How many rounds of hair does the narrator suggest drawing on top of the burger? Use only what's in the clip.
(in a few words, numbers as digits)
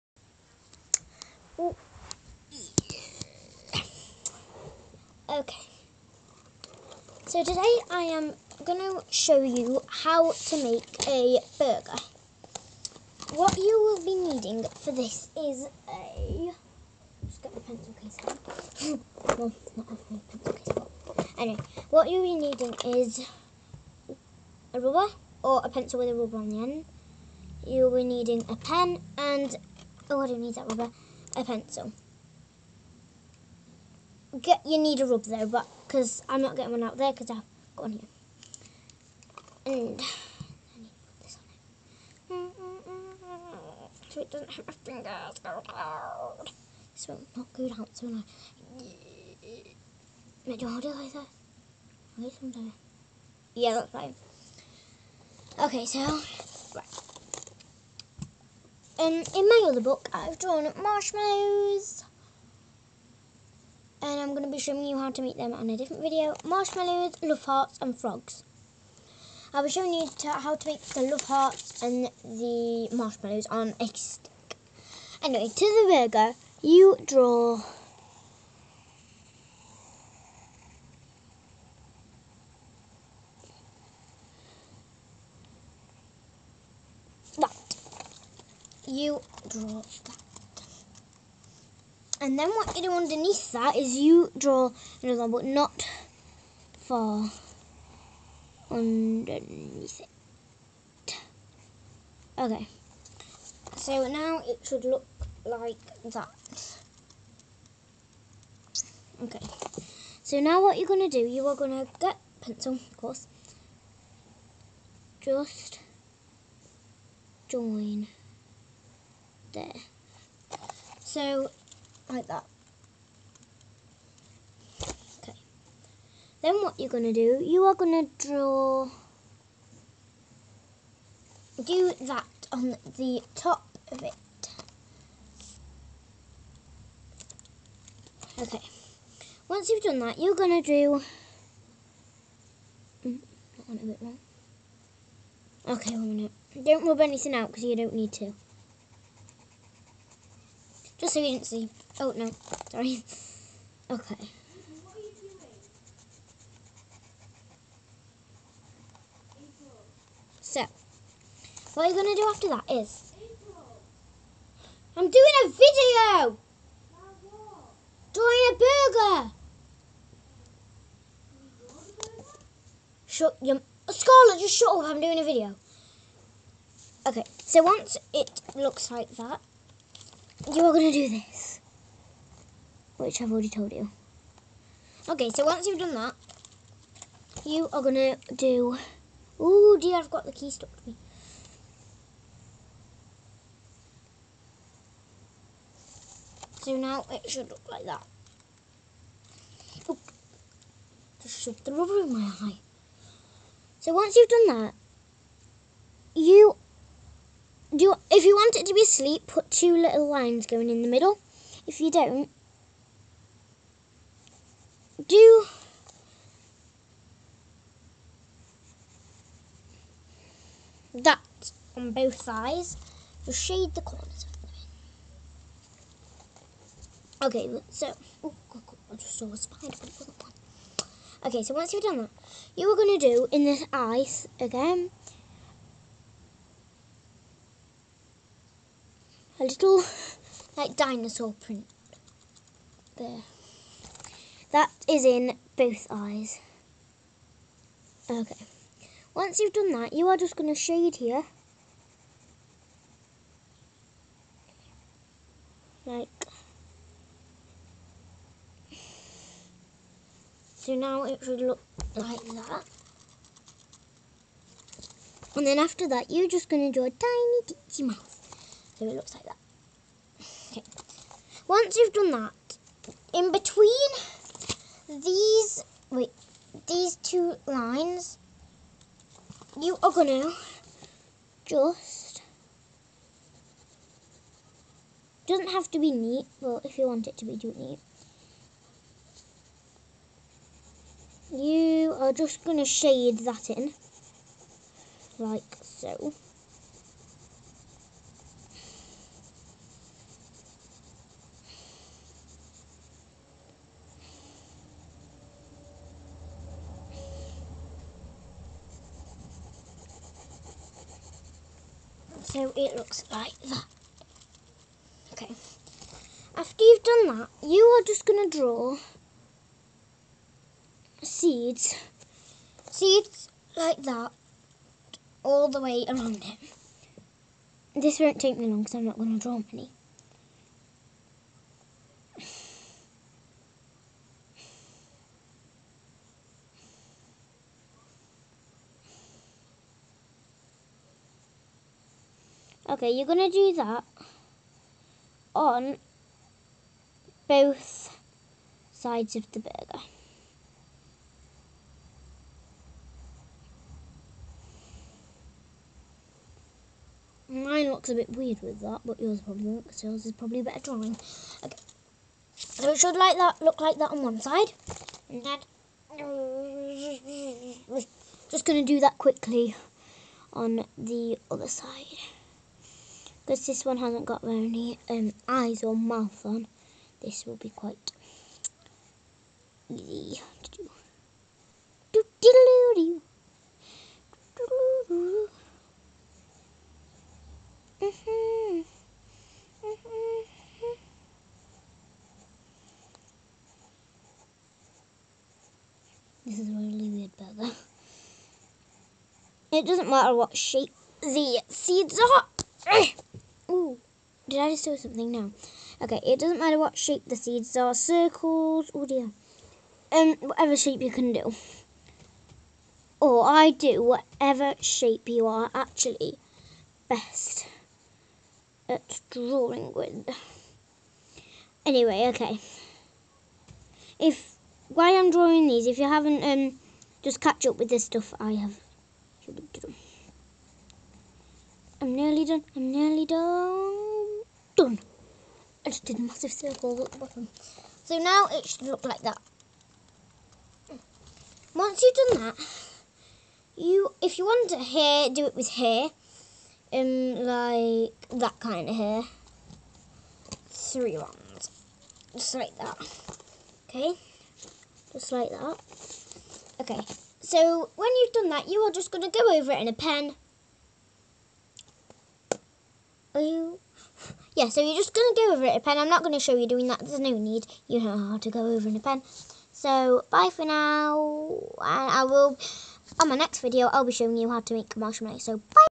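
3.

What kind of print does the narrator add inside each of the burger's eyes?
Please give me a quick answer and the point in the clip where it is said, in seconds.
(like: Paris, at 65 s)
Dinosaur print, at 240 s.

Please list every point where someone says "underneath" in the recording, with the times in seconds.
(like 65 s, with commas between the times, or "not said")
92 s, 98 s.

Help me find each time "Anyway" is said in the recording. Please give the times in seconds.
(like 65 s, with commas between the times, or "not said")
21 s, 75 s, 421 s.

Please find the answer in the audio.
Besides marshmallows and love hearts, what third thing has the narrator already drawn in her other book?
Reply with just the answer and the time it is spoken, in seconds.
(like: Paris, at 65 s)
Frogs, at 67 s.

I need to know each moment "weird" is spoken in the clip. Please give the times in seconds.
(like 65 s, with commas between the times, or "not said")
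358 s, 396 s.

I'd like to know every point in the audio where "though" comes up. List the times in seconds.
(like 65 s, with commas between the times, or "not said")
35 s.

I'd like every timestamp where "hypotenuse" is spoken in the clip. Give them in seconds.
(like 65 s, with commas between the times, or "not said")
not said.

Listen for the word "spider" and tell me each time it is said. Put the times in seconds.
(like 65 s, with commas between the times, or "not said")
229 s.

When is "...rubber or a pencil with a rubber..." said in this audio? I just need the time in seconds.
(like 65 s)
24 s.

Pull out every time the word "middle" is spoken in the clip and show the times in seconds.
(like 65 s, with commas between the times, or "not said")
210 s.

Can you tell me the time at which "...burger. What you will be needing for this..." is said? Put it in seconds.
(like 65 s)
11 s.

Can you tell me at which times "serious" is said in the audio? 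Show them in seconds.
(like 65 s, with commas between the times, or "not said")
not said.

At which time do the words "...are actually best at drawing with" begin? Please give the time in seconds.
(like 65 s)
415 s.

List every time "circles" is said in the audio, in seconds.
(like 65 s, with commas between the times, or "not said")
407 s, 436 s.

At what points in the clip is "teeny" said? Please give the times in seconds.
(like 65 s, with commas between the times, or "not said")
267 s.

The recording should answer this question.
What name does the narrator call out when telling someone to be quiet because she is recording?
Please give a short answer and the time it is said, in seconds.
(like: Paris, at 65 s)
Scarlett, at 173 s.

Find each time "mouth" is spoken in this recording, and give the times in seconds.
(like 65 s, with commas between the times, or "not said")
267 s, 375 s.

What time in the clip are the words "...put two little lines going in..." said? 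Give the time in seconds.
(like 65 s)
209 s.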